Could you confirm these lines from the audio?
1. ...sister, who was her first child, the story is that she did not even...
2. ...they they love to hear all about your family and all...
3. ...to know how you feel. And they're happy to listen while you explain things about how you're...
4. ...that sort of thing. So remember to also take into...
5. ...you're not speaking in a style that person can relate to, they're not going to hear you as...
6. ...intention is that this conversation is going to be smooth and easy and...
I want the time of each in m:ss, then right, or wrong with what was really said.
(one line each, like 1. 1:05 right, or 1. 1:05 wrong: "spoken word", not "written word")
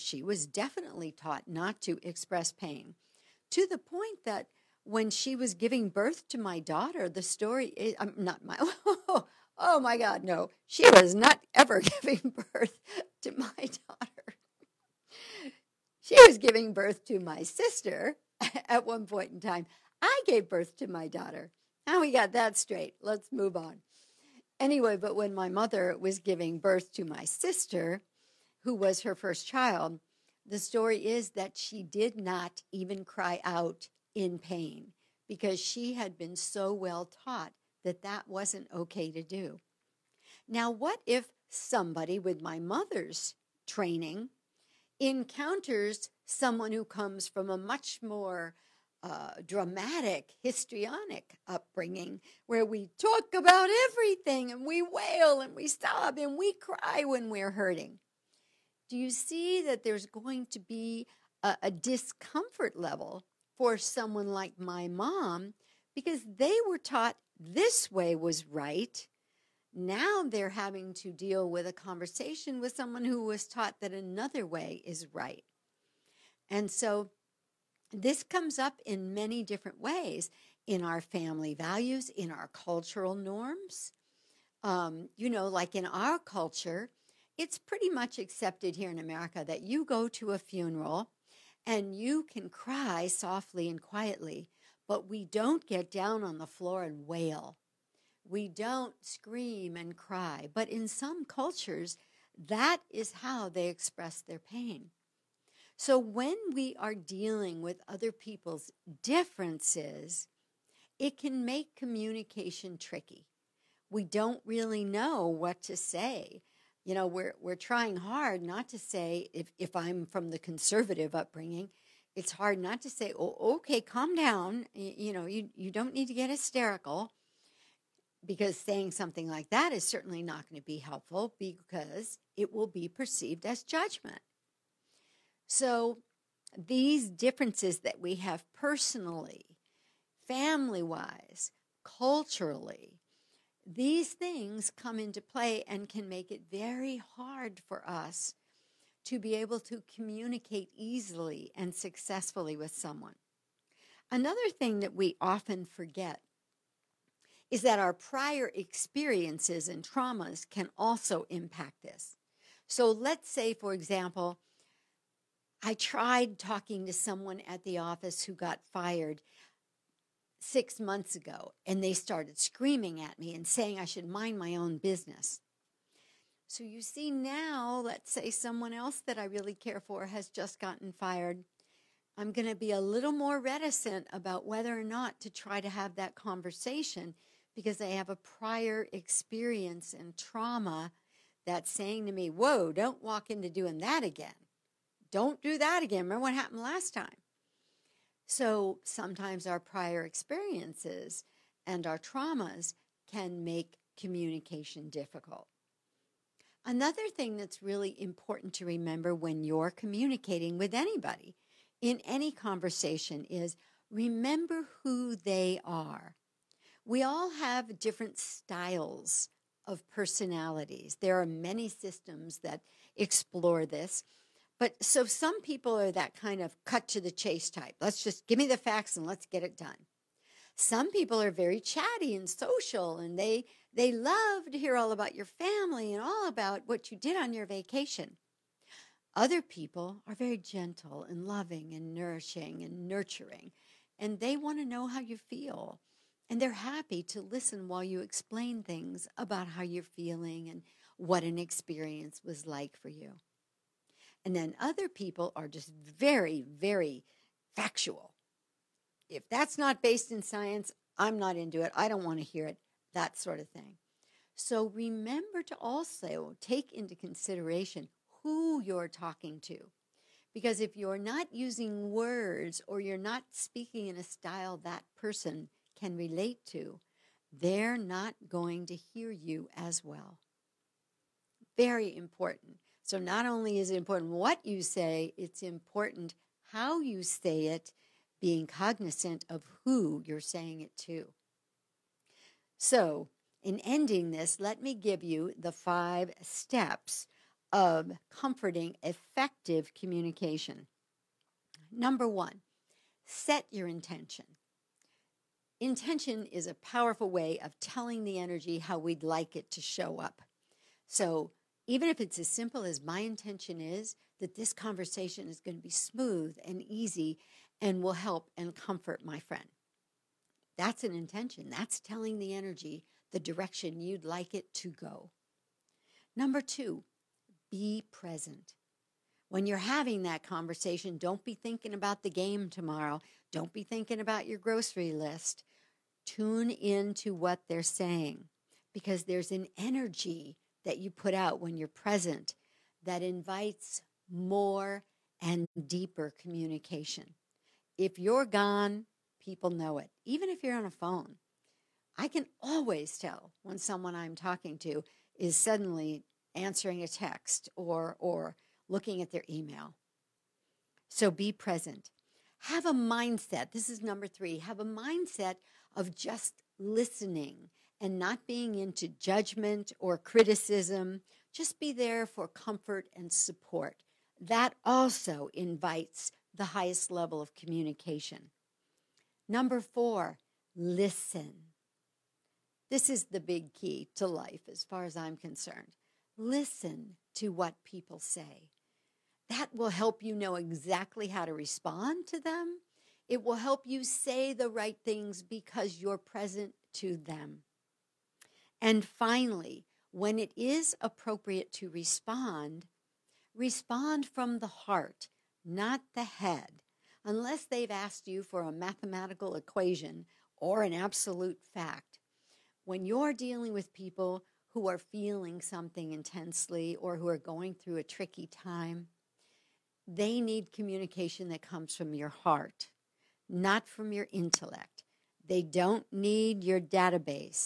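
1. 0:27 right
2. 3:53 right
3. 4:04 right
4. 4:22 right
5. 4:32 right
6. 5:13 right.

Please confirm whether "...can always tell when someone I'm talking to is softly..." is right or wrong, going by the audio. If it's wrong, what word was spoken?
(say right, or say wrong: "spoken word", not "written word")
wrong: "suddenly", not "softly".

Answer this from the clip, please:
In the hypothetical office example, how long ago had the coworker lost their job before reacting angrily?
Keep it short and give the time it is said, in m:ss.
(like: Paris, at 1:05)
6 months, at 2:50.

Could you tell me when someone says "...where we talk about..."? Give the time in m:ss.
0:52.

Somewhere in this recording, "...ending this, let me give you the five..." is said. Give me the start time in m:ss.
4:53.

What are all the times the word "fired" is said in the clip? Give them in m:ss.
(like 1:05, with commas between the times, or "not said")
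2:48, 3:00.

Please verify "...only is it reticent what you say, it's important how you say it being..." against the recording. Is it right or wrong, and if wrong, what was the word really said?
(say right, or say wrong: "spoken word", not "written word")
wrong: "important", not "reticent".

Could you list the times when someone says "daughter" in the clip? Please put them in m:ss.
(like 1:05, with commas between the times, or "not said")
0:06, 0:13, 0:21.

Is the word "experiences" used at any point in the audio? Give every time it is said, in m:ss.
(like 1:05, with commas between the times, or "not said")
2:38, 3:08, 3:20, 4:11.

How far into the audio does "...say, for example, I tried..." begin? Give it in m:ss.
2:43.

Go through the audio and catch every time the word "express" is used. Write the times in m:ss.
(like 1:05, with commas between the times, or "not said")
0:02, 1:43.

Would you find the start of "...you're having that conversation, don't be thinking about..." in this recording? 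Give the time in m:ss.
5:29.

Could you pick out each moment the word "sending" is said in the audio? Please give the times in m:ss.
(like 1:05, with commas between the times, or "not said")
not said.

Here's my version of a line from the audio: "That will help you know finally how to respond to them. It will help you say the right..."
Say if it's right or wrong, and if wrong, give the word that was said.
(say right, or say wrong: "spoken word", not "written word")
wrong: "exactly", not "finally".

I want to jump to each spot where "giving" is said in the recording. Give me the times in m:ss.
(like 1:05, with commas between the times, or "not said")
0:05, 0:12, 0:16, 0:26.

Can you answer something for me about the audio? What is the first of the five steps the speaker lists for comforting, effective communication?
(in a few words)
set your intention.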